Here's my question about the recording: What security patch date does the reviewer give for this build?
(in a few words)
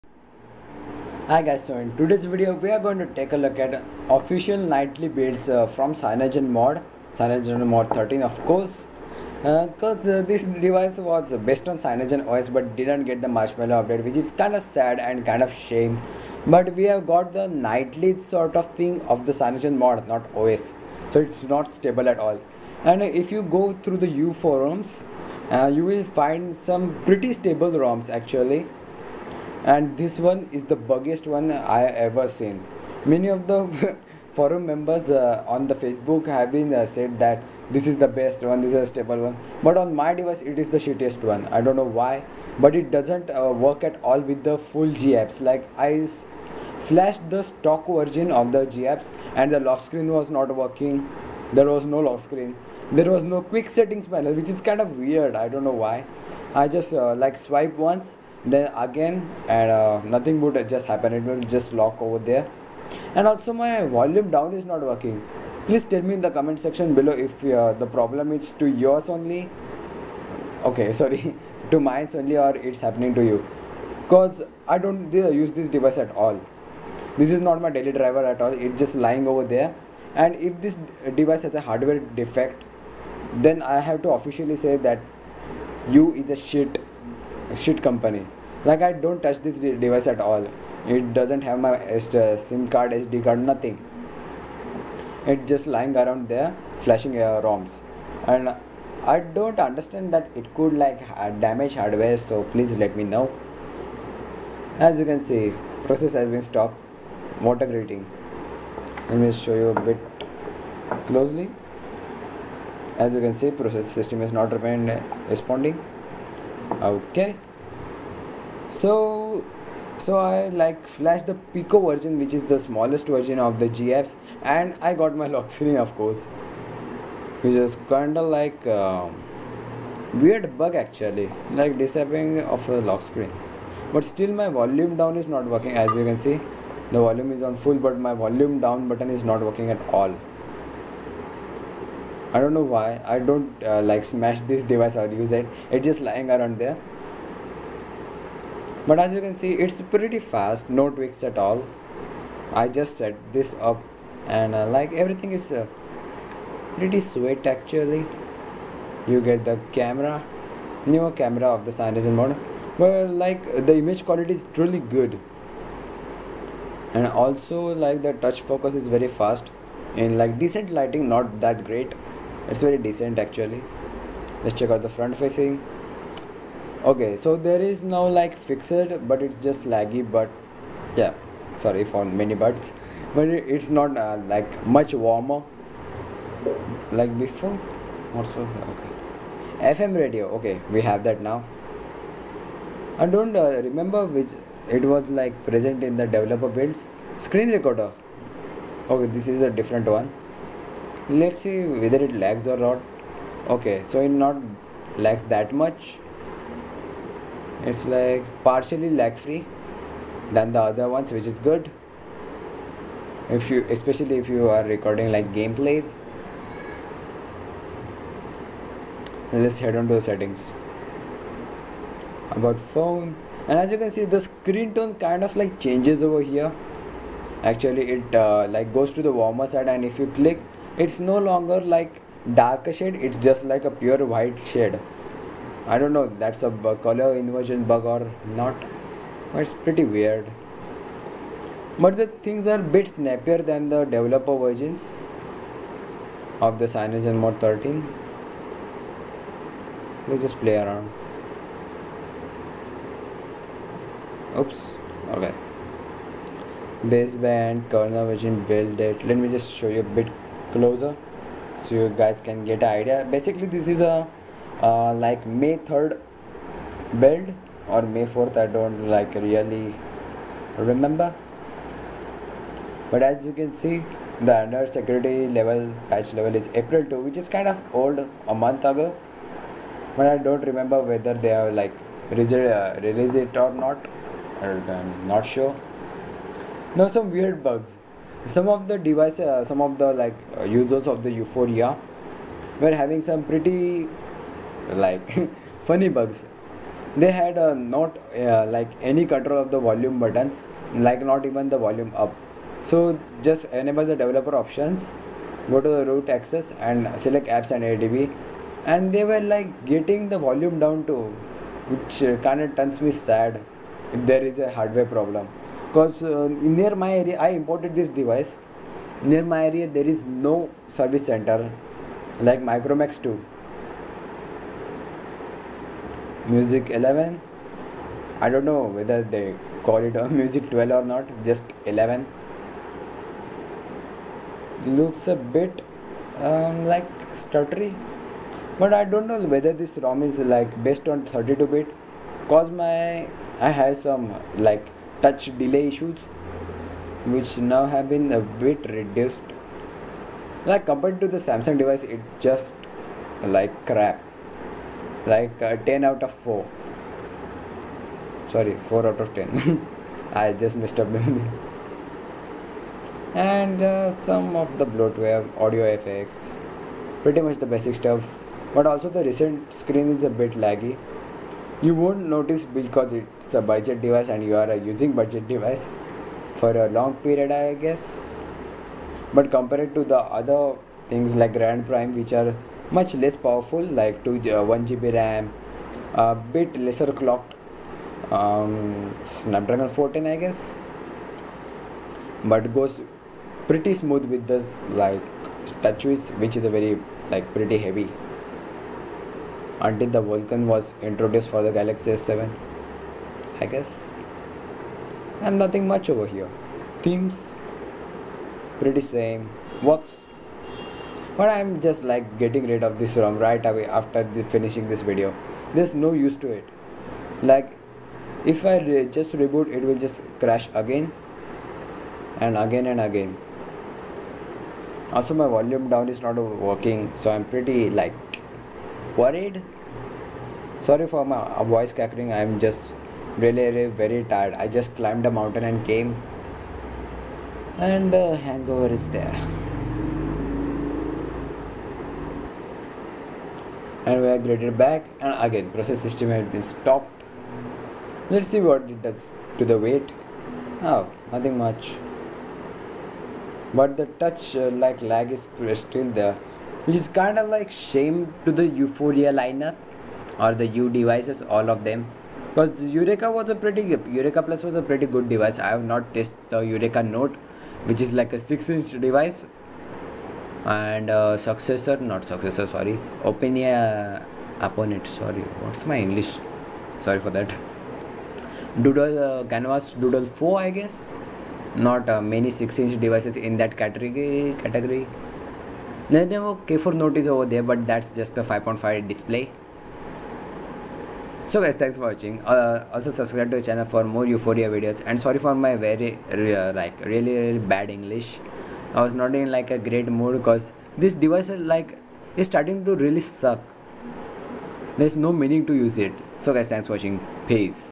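April 2.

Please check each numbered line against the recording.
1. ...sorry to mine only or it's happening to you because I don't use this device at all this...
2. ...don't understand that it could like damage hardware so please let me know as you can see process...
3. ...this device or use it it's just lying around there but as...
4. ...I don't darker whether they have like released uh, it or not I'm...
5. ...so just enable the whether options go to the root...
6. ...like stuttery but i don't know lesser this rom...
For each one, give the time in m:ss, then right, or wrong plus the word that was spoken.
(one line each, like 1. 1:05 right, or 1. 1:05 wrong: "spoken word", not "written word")
1. 1:10 right
2. 1:39 right
3. 2:24 right
4. 4:40 wrong: "remember", not "darker"
5. 5:02 wrong: "developer", not "whether"
6. 5:36 wrong: "whether", not "lesser".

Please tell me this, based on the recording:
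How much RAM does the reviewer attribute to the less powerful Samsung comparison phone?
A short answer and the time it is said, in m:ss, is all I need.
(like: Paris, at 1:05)
1 GB, at 6:24.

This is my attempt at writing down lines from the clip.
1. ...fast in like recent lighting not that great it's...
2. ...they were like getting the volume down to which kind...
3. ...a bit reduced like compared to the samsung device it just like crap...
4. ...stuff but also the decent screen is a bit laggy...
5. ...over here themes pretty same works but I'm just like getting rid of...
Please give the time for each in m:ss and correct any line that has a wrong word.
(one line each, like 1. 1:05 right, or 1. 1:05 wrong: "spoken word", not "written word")
1. 2:49 wrong: "decent", not "recent"
2. 5:08 right
3. 5:48 right
4. 6:07 wrong: "recent", not "decent"
5. 6:45 right.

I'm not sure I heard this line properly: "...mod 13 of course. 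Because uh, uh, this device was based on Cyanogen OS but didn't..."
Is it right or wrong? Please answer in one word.
right.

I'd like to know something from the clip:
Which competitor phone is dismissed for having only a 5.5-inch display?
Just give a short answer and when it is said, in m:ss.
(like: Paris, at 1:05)
K4 Note, at 8:06.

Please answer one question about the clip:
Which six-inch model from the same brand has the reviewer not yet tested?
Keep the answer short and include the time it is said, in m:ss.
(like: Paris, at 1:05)
Yureka Note, at 7:46.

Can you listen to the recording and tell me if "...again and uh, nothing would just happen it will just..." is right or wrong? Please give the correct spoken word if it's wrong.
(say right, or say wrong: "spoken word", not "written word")
right.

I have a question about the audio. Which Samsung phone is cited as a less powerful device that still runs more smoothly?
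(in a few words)
Grand Prime.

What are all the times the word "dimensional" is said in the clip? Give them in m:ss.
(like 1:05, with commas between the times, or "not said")
not said.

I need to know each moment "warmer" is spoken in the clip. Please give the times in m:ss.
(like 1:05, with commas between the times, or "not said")
3:04, 3:49.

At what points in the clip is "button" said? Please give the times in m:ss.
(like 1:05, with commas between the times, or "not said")
2:18, 4:59.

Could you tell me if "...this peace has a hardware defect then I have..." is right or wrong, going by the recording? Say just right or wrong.
wrong.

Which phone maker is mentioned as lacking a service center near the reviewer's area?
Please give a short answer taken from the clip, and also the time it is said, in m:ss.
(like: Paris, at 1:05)
Micromax, at 5:22.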